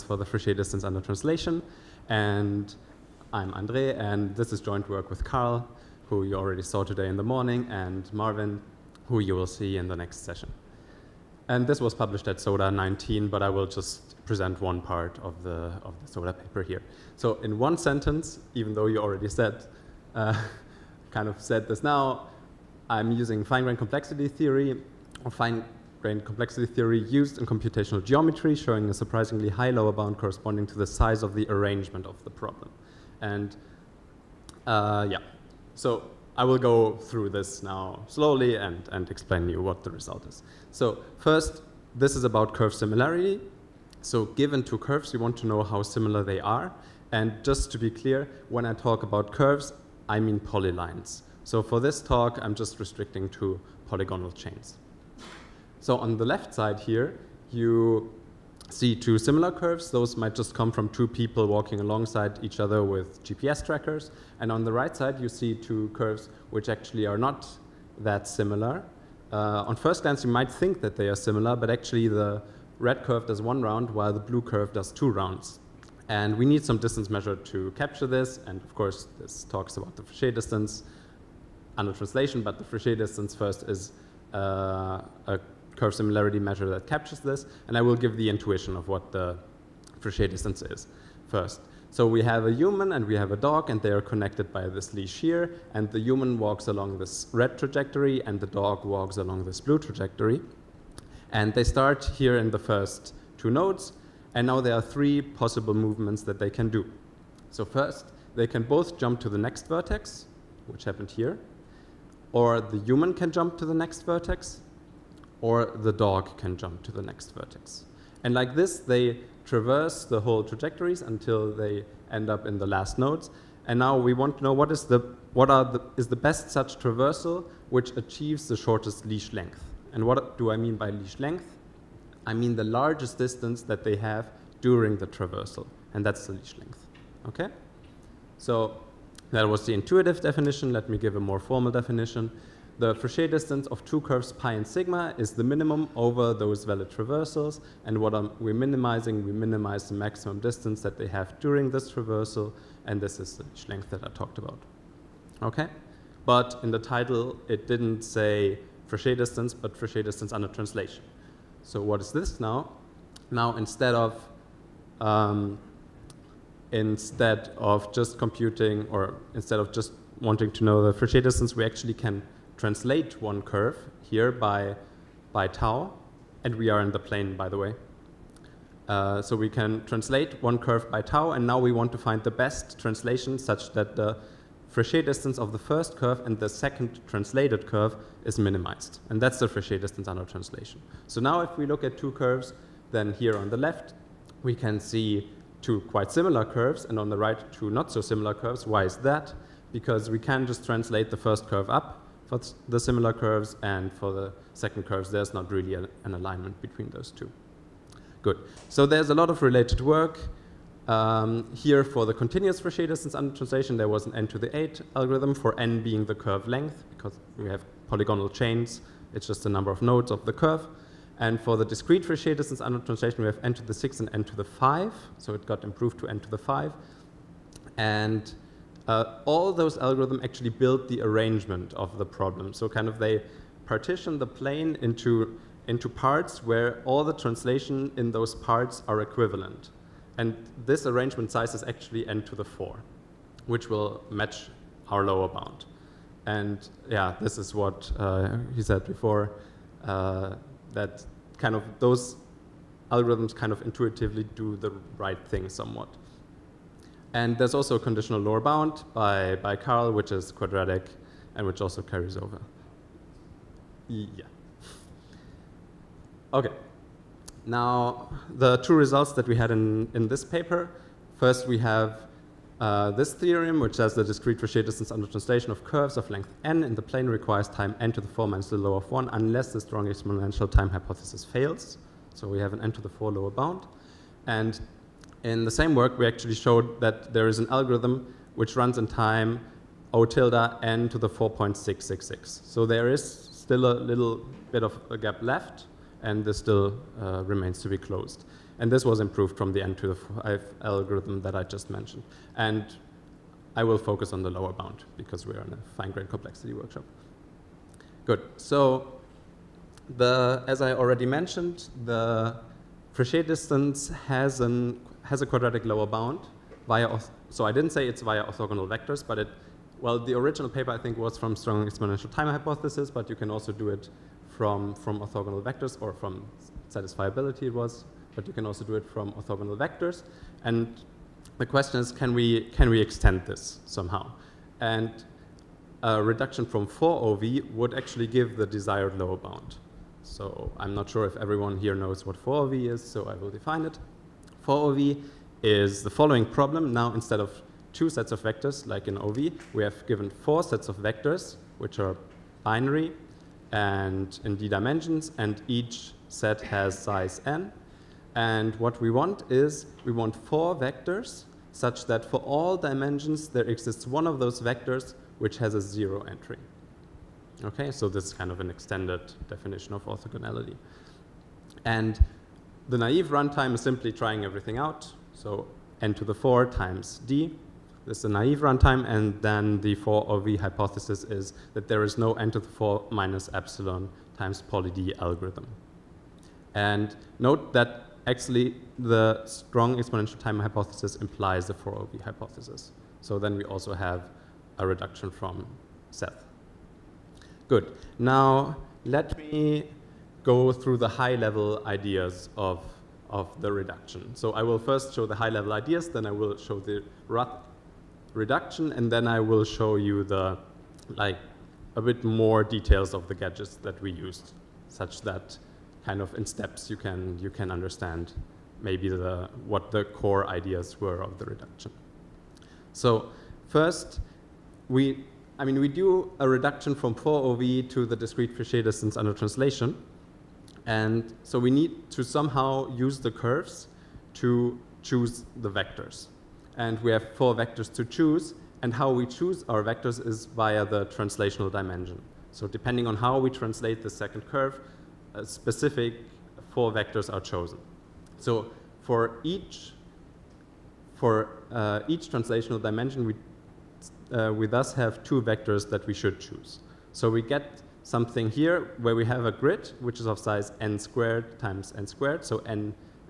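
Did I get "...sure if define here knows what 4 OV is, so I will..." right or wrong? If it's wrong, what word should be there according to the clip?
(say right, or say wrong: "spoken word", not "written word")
wrong: "everyone", not "define".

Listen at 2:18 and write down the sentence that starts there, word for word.
So that was the intuitive definition.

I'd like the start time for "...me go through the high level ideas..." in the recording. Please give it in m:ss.
6:39.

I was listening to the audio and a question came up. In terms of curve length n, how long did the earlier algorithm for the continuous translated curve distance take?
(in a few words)
n to the 8.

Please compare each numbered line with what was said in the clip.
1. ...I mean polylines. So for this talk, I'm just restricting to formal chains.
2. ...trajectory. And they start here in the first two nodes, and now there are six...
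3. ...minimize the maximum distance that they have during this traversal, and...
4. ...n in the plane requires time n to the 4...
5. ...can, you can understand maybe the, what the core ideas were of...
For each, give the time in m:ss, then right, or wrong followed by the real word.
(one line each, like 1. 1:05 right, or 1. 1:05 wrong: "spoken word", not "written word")
1. 0:50 wrong: "polygonal", not "formal"
2. 1:39 wrong: "three", not "six"
3. 2:29 right
4. 4:36 right
5. 6:56 right.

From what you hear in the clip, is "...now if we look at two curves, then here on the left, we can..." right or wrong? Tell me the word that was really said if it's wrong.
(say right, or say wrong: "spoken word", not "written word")
right.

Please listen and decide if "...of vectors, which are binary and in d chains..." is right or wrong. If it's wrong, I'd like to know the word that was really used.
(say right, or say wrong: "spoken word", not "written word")
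wrong: "dimensions", not "chains".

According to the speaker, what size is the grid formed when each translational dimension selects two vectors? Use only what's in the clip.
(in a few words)
n squared times n squared.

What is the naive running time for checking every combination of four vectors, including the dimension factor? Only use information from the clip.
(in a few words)
n^4 times d.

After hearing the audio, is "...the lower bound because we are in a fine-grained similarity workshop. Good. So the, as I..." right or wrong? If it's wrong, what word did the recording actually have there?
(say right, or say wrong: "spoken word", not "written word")
wrong: "complexity", not "similarity".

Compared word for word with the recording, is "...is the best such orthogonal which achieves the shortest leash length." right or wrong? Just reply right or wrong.
wrong.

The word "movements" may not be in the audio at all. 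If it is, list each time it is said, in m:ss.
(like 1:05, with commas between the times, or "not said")
1:45.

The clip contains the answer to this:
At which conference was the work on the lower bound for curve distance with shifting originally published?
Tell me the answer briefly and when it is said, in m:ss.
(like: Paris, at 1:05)
SODA 19, at 0:12.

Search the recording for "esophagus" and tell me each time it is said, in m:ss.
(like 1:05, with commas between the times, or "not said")
not said.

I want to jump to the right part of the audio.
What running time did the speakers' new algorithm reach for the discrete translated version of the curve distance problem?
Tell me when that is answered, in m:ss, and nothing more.
4:50.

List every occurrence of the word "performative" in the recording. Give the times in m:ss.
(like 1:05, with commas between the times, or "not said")
not said.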